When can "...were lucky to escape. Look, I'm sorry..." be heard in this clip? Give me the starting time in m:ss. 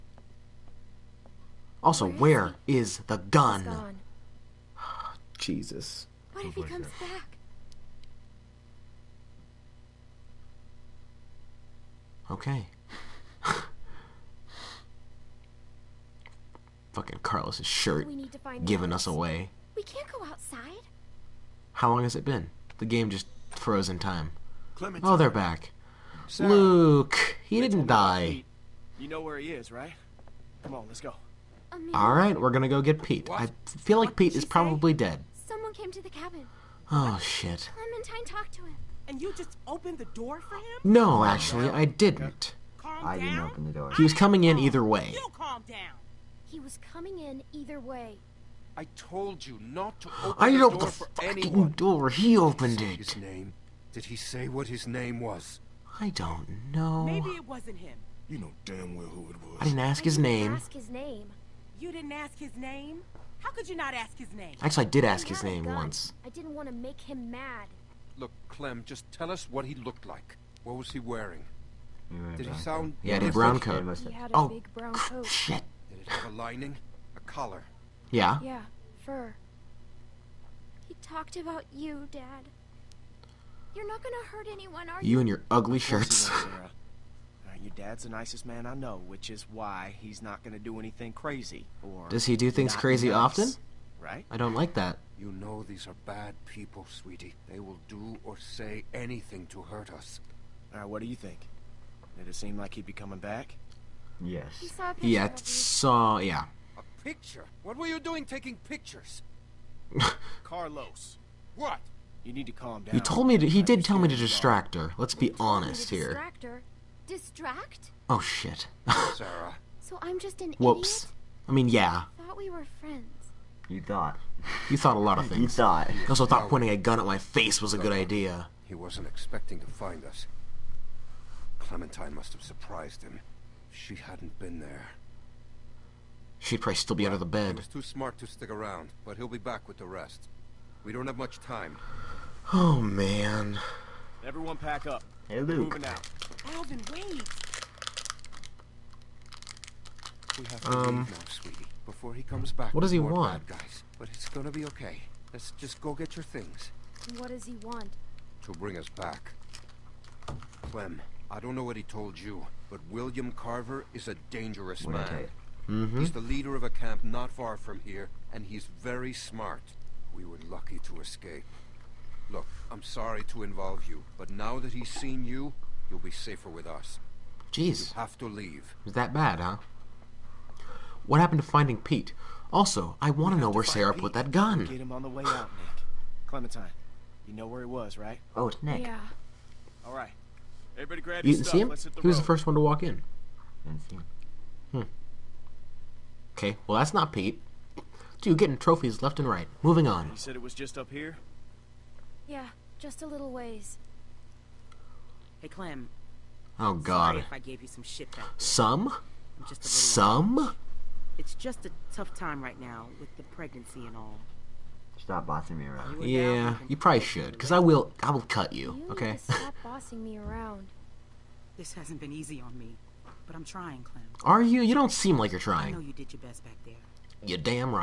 2:50.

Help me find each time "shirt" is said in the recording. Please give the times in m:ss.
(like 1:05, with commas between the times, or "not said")
0:17, 1:25.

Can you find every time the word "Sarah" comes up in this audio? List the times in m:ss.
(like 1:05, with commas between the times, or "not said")
0:26, 1:59, 3:03.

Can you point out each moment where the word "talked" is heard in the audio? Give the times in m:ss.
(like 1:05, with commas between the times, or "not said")
0:38, 1:21.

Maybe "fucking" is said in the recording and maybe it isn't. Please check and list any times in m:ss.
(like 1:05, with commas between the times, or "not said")
0:16, 0:51.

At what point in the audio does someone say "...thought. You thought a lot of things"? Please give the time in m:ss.
2:03.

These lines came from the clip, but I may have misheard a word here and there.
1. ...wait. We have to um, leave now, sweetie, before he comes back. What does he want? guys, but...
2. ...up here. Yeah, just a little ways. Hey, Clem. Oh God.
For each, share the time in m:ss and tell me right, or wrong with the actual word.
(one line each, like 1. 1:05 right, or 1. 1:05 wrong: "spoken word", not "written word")
1. 2:26 right
2. 3:20 right.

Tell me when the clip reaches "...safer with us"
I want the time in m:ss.
2:56.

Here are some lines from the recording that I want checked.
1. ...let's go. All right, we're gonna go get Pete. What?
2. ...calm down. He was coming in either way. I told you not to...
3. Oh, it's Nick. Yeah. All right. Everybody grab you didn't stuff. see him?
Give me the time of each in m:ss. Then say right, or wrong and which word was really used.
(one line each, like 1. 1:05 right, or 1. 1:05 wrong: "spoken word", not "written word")
1. 0:30 right
2. 0:45 right
3. 3:08 right.